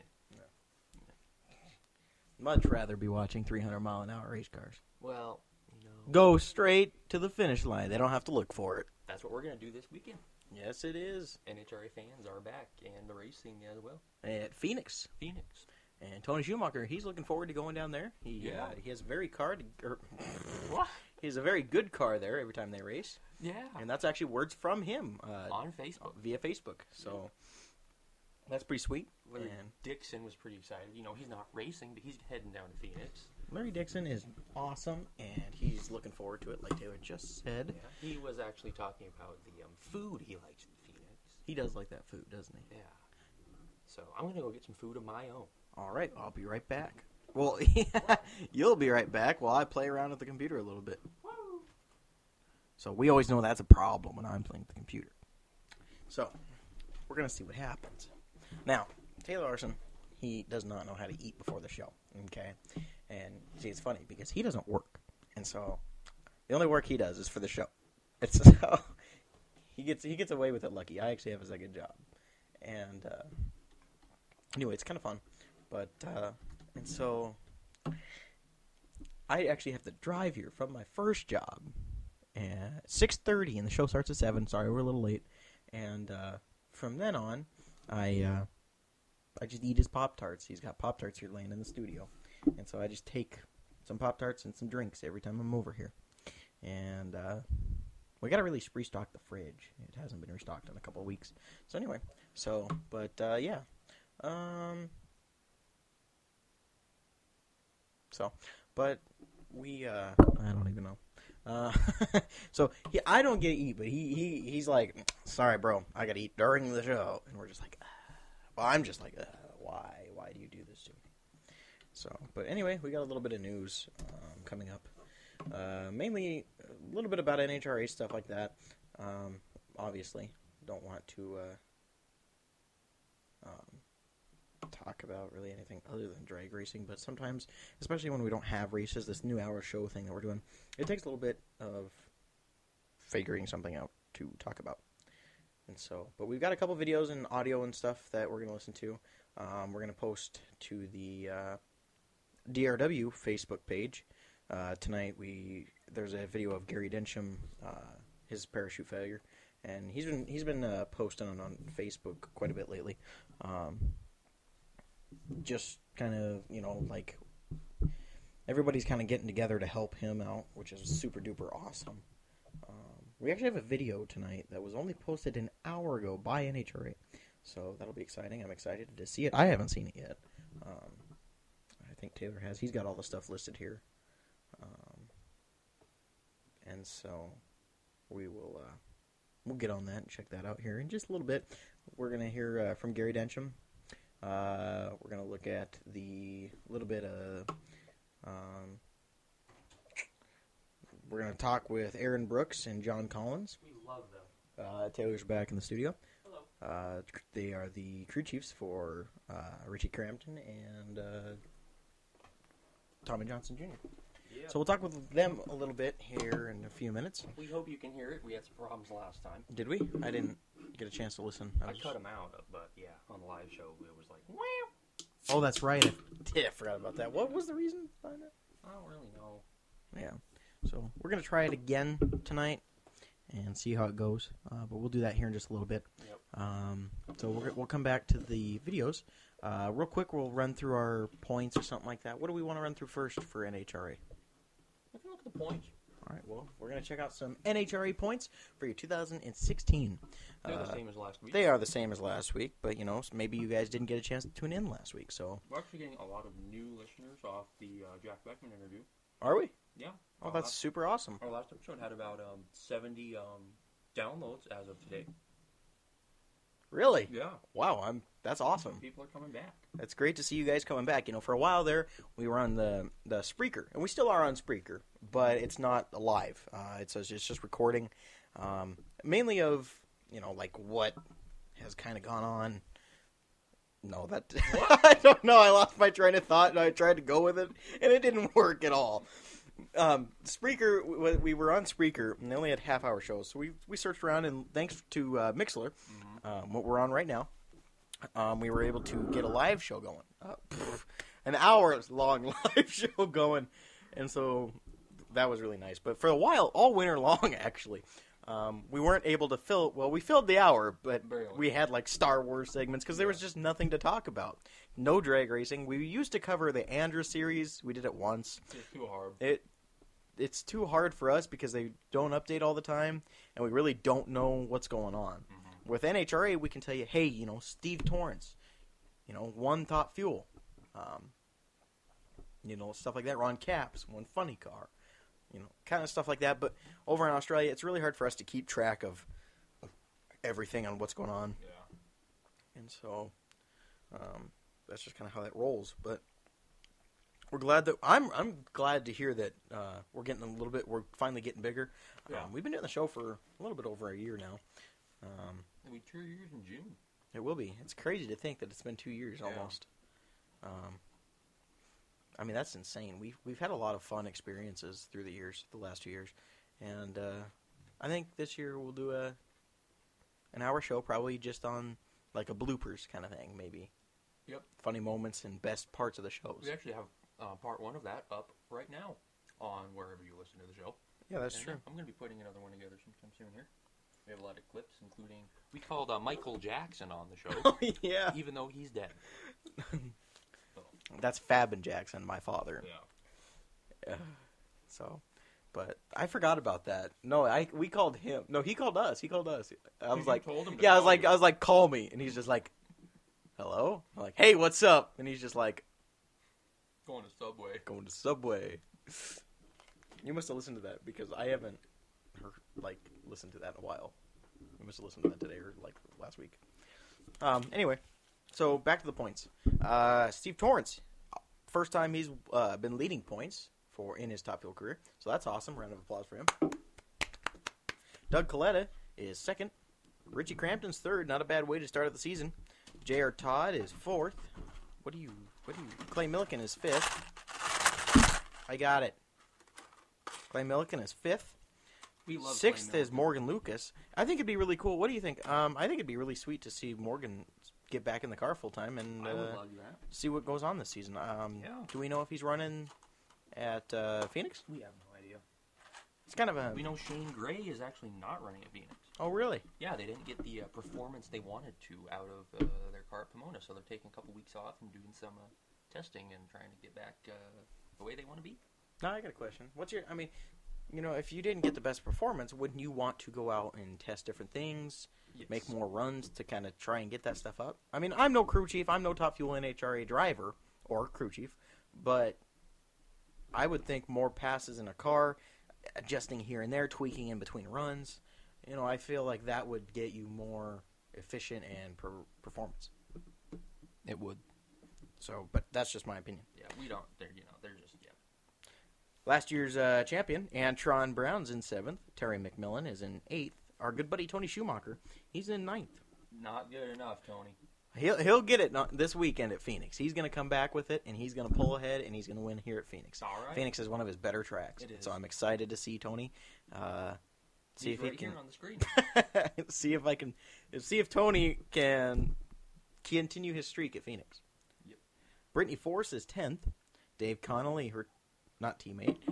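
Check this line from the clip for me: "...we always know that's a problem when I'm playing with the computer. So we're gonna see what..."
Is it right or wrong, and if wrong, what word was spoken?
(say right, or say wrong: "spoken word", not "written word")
right.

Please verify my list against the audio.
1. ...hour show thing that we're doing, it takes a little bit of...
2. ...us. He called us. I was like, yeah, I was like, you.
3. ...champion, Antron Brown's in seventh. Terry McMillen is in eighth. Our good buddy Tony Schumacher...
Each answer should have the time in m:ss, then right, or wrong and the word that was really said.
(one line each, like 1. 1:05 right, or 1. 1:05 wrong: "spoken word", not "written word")
1. 2:19 right
2. 6:38 right
3. 8:19 right.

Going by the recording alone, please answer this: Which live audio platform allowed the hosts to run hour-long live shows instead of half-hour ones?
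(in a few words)
Mixlr.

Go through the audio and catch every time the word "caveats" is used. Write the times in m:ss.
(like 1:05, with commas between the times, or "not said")
not said.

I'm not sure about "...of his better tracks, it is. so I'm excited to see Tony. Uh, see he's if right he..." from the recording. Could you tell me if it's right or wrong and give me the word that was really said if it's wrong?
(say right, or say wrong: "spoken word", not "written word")
right.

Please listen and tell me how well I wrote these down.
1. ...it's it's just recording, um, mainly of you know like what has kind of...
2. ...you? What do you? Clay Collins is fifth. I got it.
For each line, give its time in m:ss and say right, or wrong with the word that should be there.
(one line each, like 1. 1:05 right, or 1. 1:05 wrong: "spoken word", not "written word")
1. 4:36 right
2. 7:15 wrong: "Millican", not "Collins".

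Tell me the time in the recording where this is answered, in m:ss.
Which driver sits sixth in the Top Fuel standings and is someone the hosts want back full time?
7:22.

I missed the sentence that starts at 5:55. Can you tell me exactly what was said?
Um, It'll be two years in June.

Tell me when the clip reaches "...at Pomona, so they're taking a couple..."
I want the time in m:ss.
7:43.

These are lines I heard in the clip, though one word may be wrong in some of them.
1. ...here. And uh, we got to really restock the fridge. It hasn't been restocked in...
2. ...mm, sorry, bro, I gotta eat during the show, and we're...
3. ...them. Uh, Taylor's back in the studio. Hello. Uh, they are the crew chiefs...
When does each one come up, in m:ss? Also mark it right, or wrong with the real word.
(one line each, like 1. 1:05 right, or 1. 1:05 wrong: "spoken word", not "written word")
1. 1:35 right
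2. 1:54 right
3. 3:24 right.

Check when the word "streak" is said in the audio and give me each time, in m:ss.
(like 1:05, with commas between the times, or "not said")
8:43.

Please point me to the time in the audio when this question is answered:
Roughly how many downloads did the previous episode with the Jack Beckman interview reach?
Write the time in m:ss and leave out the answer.
4:22.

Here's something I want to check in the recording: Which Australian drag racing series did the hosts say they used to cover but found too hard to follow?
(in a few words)
ANDRA.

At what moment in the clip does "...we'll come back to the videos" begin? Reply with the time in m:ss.
3:57.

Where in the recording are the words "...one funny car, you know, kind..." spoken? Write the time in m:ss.
5:33.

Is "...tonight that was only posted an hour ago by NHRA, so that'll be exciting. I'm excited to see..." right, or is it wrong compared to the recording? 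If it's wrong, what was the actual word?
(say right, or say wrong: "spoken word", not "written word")
right.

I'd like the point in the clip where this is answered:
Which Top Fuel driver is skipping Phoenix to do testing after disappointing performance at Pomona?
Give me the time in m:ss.
7:36.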